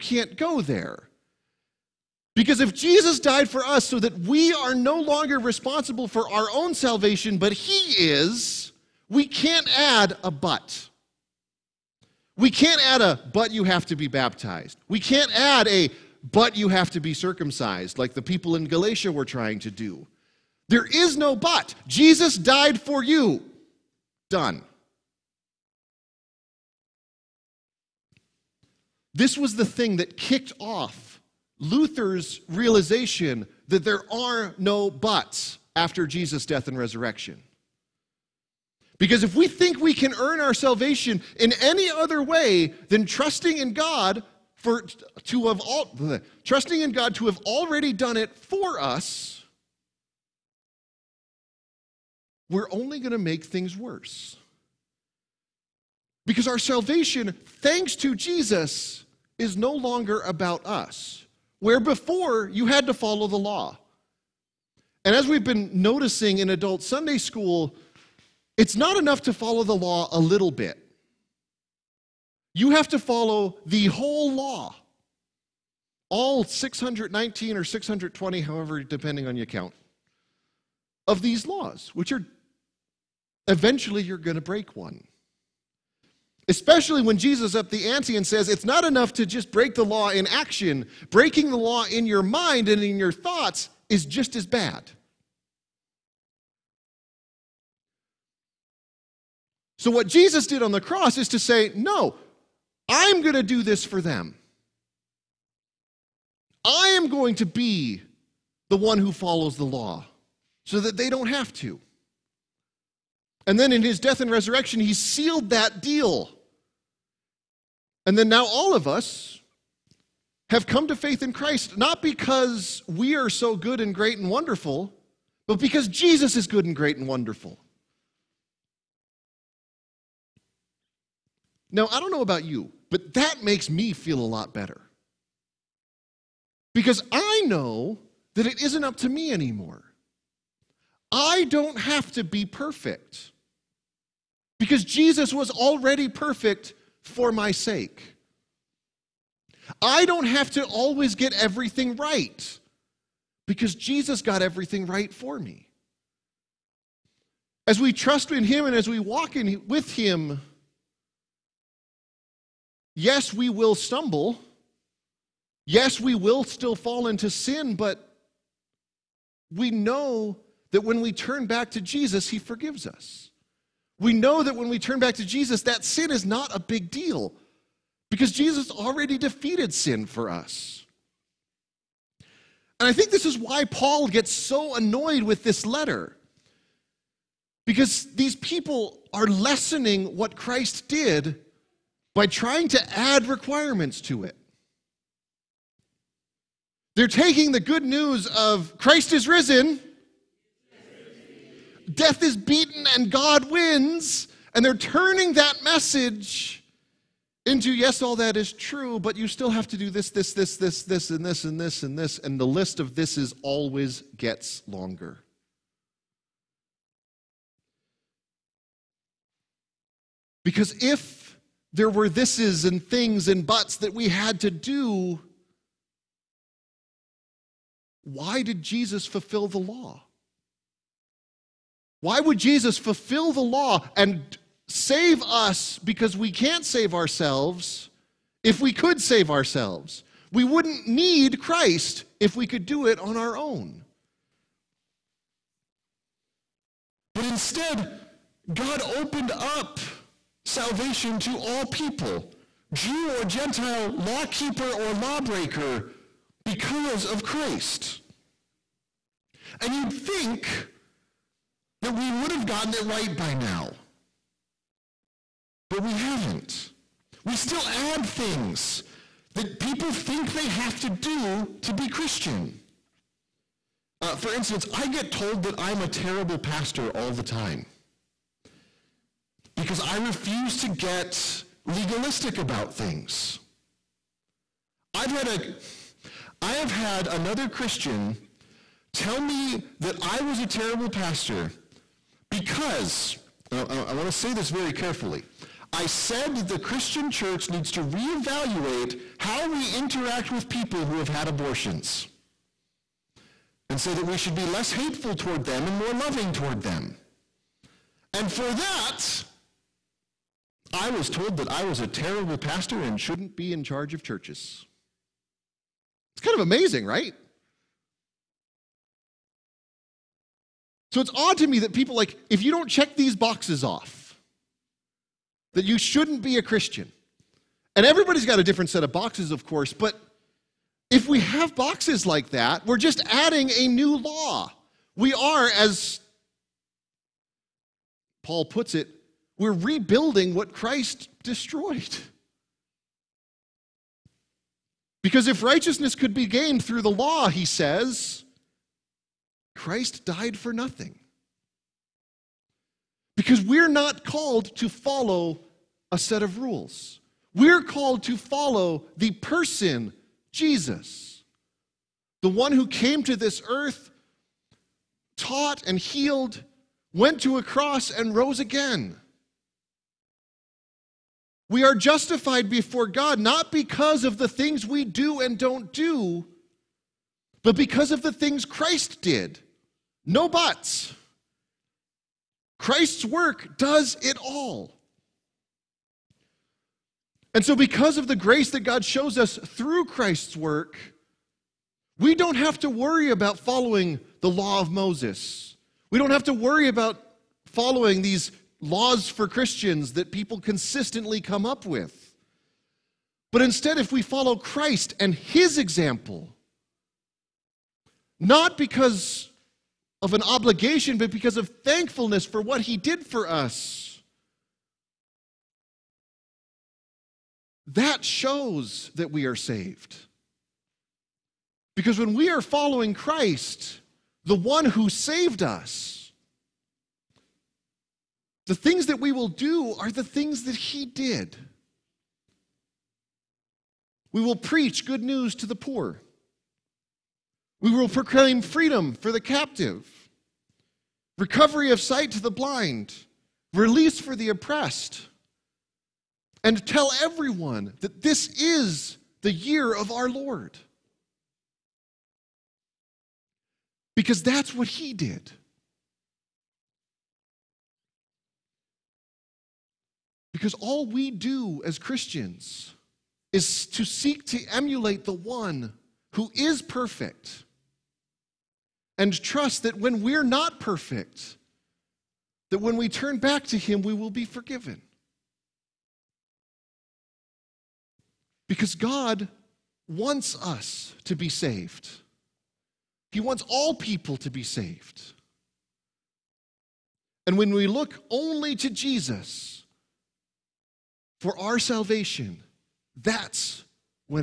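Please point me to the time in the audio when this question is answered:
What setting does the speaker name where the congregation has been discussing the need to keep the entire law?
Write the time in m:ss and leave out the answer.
1:06.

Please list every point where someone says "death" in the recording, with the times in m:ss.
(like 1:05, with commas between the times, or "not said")
0:36, 1:53, 3:21.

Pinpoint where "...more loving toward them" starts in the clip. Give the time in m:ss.
5:05.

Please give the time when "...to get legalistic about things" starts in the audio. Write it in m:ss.
4:40.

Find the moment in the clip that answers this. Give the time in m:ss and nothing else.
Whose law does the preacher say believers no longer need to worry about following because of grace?
6:34.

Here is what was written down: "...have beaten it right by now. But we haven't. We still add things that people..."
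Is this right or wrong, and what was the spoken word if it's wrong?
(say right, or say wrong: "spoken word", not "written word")
wrong: "gotten", not "beaten".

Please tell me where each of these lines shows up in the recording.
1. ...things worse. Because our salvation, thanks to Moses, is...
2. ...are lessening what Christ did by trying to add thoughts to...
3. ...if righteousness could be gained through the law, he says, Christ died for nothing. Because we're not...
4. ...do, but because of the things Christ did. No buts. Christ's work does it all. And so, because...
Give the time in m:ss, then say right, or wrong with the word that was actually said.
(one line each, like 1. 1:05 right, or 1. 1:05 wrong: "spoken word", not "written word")
1. 0:53 wrong: "Jesus", not "Moses"
2. 3:09 wrong: "requirements", not "thoughts"
3. 5:45 right
4. 6:15 right.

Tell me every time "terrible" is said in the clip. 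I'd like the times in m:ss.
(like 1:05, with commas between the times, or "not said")
4:35, 4:50, 5:11.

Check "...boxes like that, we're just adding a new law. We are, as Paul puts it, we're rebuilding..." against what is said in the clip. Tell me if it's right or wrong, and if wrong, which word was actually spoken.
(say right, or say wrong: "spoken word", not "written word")
right.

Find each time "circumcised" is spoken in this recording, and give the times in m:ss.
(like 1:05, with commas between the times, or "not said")
0:17.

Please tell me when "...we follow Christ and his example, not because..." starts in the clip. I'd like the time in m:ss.
6:43.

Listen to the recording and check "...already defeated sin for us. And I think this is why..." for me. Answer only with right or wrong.
right.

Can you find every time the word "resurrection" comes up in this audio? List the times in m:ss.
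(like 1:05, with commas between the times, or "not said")
0:36, 1:54.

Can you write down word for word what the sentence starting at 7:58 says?
Because God wants us to be saved, He wants all people to be saved.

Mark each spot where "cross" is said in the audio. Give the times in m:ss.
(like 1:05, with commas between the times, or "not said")
1:40, 6:07.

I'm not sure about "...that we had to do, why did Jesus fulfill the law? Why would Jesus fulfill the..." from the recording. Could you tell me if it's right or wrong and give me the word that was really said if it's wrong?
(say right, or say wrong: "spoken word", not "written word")
right.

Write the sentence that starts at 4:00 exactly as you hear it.
We wouldn't need Christ if we could do it on our own.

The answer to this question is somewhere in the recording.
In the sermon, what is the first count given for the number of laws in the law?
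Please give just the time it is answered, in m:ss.
1:16.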